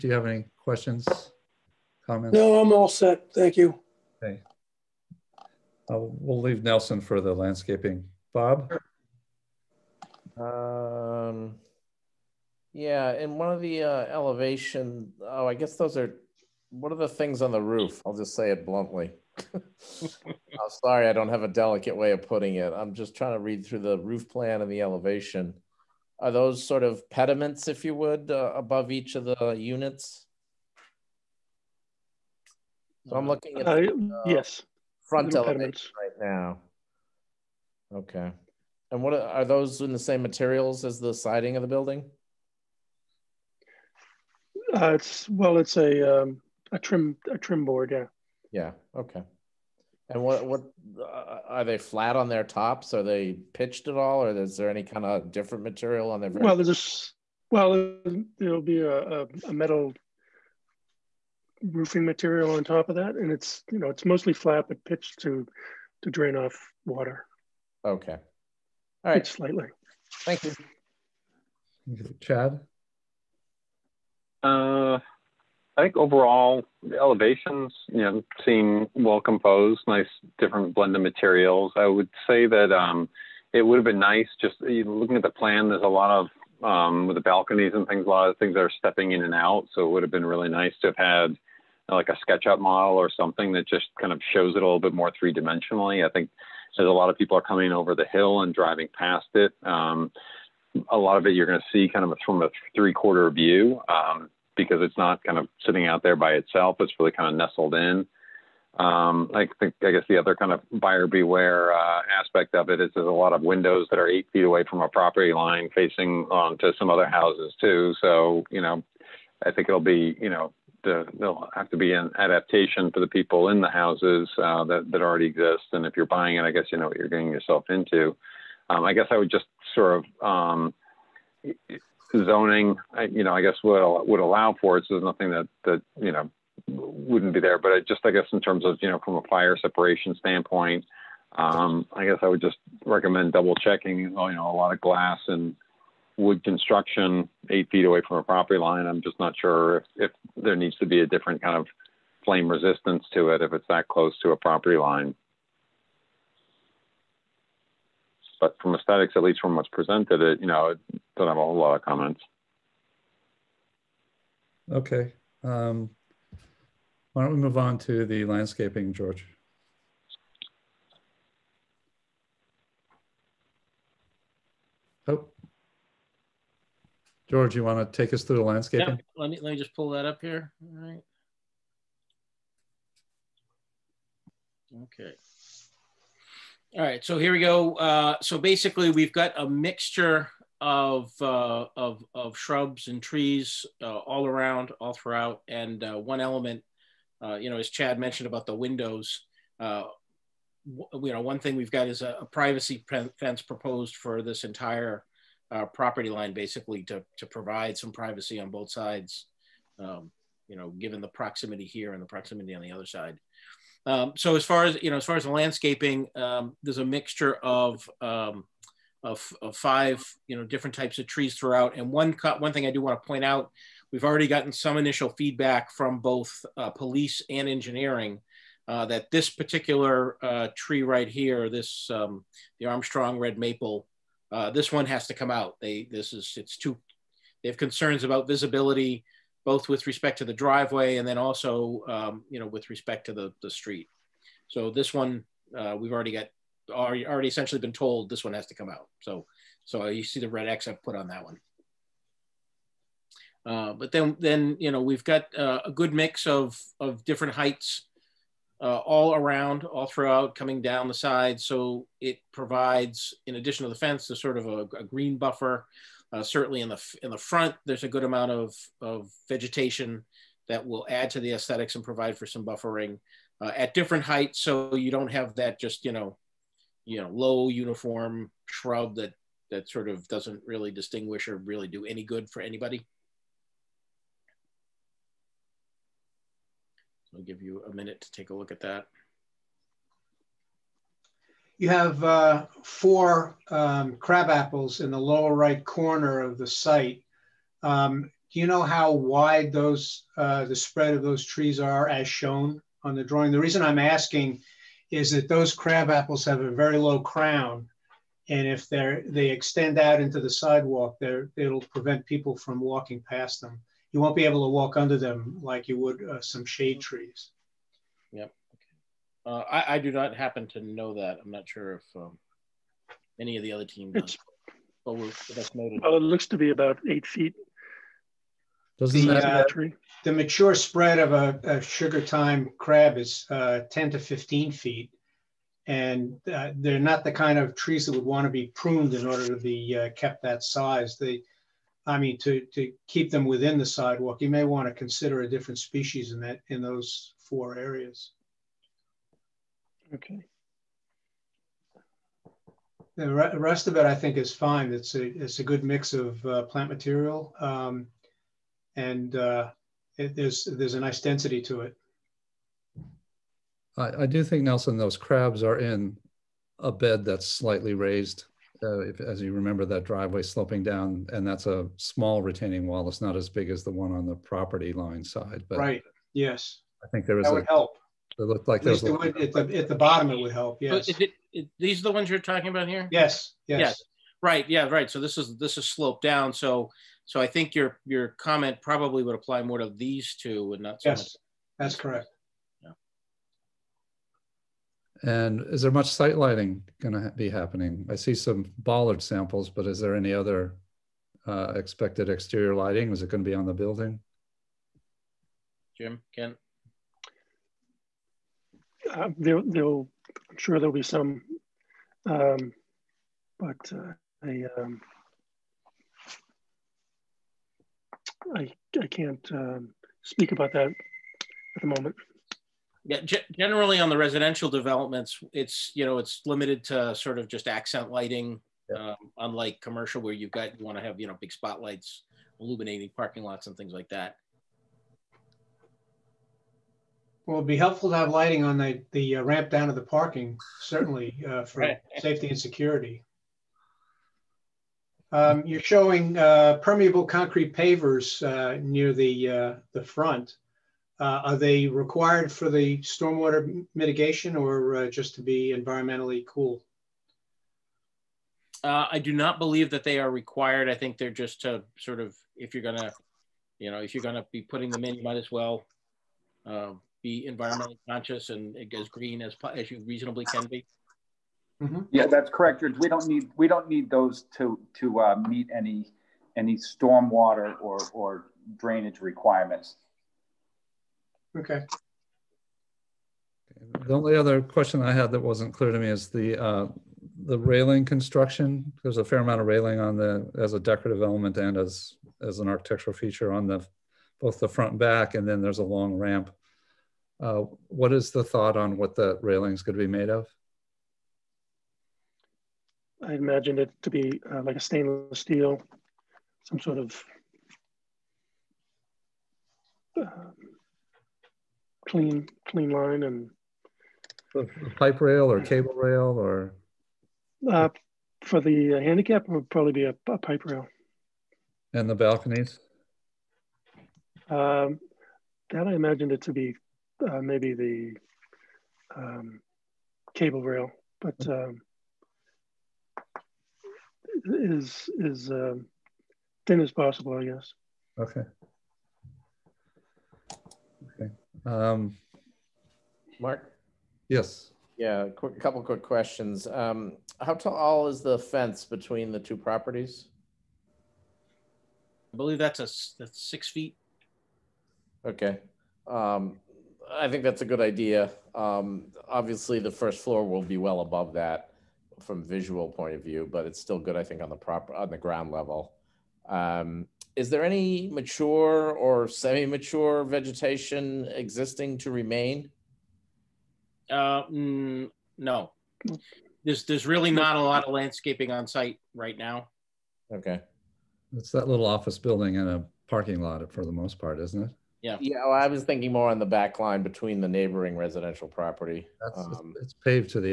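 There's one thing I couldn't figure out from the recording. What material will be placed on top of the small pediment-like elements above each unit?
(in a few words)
metal roofing.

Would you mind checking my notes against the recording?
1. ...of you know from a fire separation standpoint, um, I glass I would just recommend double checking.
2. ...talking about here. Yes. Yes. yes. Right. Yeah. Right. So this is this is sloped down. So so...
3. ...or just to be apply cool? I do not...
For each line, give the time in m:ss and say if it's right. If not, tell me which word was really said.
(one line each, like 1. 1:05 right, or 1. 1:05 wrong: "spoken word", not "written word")
1. 2:18 wrong: "guess", not "glass"
2. 6:22 right
3. 7:34 wrong: "environmentally", not "apply".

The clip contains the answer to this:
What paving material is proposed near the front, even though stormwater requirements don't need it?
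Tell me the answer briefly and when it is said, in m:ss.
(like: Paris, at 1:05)
permeable concrete pavers, at 7:26.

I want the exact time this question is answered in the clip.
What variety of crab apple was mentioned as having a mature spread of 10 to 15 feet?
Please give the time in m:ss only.
5:31.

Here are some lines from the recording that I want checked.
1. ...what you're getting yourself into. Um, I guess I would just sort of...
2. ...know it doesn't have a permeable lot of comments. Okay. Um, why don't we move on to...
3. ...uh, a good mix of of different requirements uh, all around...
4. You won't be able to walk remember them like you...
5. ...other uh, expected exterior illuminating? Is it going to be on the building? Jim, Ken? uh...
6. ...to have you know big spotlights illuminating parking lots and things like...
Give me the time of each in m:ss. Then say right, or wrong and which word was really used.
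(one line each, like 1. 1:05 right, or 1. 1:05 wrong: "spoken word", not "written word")
1. 2:06 right
2. 2:40 wrong: "whole", not "permeable"
3. 4:15 wrong: "heights", not "requirements"
4. 5:13 wrong: "under", not "remember"
5. 6:40 wrong: "lighting", not "illuminating"
6. 7:10 right.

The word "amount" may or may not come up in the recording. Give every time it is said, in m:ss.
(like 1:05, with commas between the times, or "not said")
4:28, 8:09.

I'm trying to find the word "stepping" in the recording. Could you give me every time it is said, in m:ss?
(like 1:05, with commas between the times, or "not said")
1:28.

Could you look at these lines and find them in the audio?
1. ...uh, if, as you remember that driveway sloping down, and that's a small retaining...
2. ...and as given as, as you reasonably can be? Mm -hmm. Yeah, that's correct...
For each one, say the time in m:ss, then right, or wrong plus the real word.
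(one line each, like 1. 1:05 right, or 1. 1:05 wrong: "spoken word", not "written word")
1. 6:08 right
2. 7:48 wrong: "green", not "given".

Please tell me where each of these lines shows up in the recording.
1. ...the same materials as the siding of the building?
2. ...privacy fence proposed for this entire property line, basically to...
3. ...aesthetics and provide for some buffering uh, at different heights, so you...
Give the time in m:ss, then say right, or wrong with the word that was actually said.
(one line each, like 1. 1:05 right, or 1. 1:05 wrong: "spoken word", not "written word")
1. 0:39 right
2. 3:22 right
3. 4:31 right.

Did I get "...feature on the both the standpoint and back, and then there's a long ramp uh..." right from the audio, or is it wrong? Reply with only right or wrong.
wrong.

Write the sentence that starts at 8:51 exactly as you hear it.
um, is is um, thin as possible, I guess.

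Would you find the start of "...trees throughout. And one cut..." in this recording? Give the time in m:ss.
3:41.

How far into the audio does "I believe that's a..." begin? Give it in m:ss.
9:12.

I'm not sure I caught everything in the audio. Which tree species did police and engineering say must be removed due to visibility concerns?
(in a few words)
Armstrong red maple.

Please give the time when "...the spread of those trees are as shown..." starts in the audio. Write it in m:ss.
5:00.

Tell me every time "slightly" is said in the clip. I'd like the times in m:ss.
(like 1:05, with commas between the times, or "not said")
1:09, 6:07.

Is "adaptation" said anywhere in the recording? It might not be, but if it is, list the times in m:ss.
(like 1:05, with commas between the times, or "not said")
2:02.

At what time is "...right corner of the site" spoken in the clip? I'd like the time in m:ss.
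4:55.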